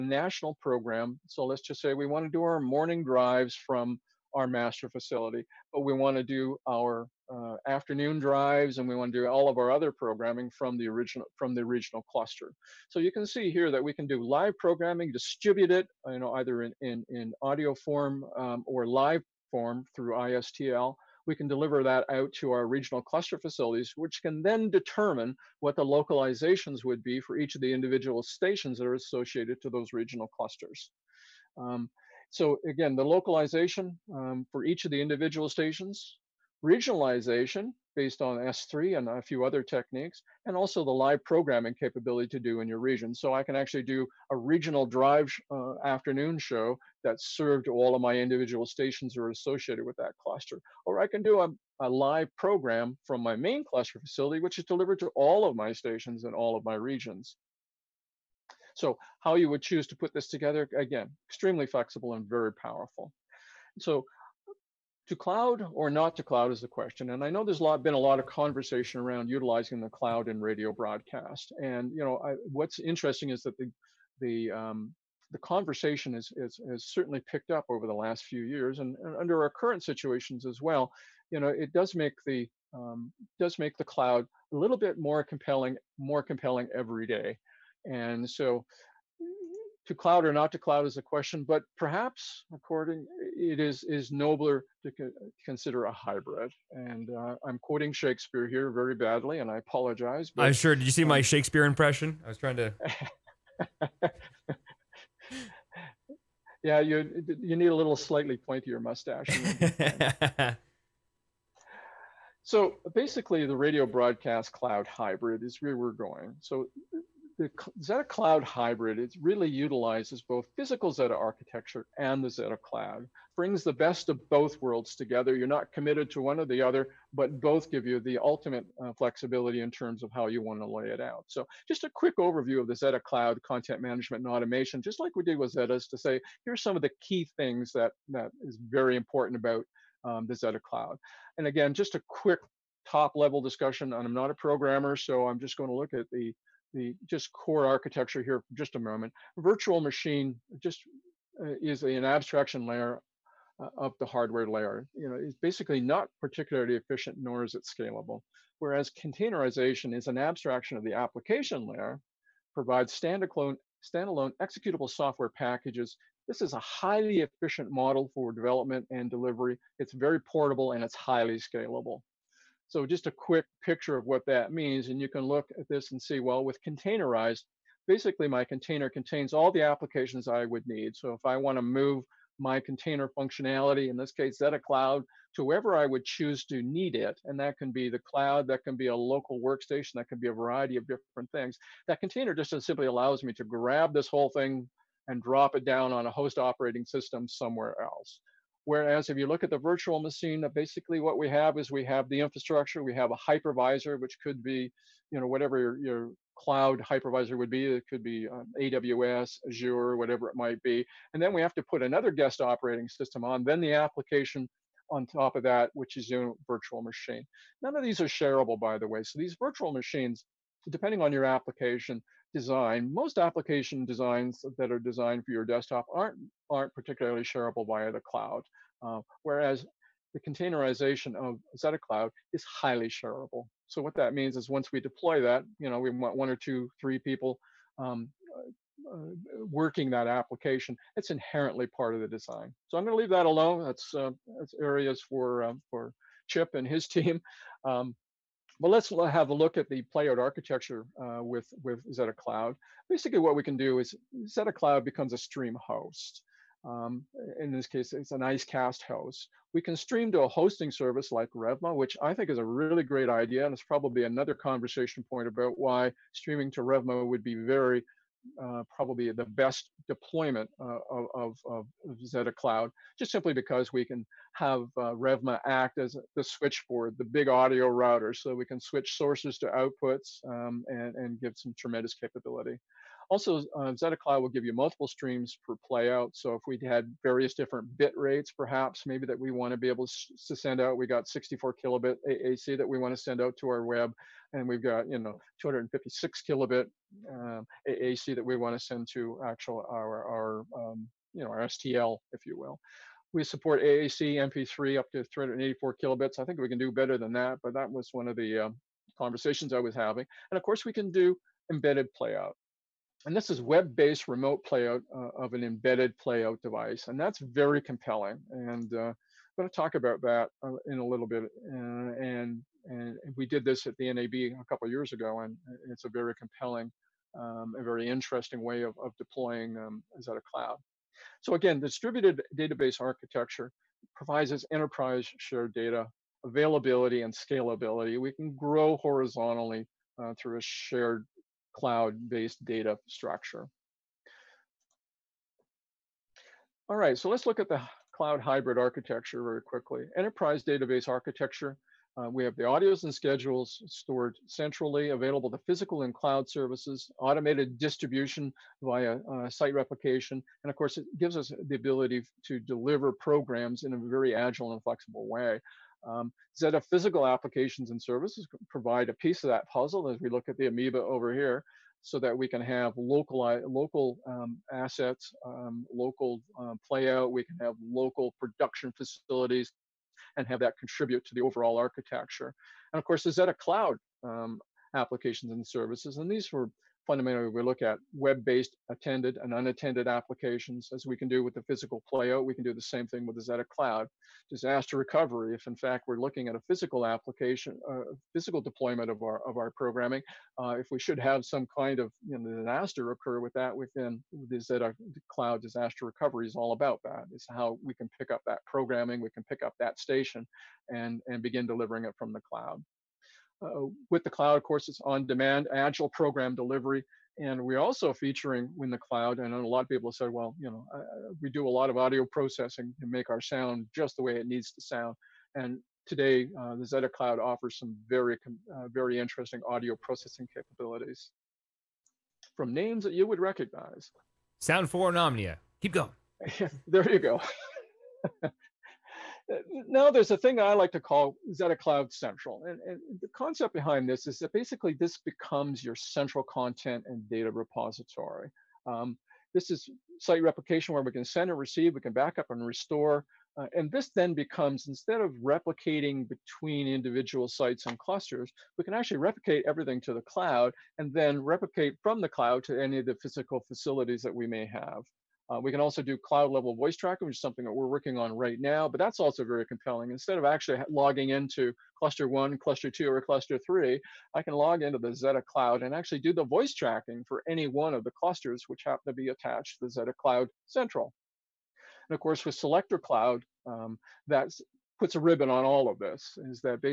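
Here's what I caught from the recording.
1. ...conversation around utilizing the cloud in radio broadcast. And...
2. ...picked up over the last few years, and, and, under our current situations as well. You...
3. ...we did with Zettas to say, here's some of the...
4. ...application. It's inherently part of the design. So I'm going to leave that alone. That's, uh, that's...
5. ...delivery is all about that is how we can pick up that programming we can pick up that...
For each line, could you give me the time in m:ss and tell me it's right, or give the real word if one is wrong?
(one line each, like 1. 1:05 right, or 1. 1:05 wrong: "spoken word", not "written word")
1. 1:08 right
2. 1:17 right
3. 2:15 right
4. 4:00 right
5. 6:45 wrong: "recovery", not "delivery".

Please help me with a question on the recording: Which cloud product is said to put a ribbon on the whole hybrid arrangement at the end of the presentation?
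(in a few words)
Selector Cloud.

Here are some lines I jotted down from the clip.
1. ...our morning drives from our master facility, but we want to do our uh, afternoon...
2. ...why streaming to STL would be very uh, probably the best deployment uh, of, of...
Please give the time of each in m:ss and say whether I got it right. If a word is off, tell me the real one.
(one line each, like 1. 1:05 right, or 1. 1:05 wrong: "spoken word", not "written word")
1. 0:02 right
2. 4:25 wrong: "Revma", not "STL".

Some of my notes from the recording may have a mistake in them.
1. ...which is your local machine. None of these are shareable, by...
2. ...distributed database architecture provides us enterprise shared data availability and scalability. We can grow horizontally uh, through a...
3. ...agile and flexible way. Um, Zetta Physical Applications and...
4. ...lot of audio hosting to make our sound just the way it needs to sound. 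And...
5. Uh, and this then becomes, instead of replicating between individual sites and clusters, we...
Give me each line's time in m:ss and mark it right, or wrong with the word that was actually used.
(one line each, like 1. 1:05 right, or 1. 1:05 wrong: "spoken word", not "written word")
1. 3:35 wrong: "virtual", not "local"
2. 5:31 right
3. 6:04 right
4. 7:01 wrong: "processing", not "hosting"
5. 7:33 right.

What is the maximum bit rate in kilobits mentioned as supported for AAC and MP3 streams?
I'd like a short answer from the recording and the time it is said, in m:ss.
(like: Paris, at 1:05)
384, at 5:05.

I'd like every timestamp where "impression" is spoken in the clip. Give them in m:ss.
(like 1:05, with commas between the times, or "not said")
1:41.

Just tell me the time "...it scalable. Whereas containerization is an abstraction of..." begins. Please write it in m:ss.
2:37.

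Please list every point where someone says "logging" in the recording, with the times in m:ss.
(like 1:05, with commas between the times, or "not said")
7:50.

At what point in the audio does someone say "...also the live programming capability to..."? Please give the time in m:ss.
0:40.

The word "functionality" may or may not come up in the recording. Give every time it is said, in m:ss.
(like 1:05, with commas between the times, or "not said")
3:03.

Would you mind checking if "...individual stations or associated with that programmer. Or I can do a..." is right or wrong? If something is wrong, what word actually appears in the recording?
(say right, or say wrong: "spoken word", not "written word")
wrong: "cluster", not "programmer".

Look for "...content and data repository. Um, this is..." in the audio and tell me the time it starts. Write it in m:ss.
7:26.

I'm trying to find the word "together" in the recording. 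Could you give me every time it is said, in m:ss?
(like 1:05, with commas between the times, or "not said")
1:00, 2:04.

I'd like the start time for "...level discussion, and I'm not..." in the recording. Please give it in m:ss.
2:23.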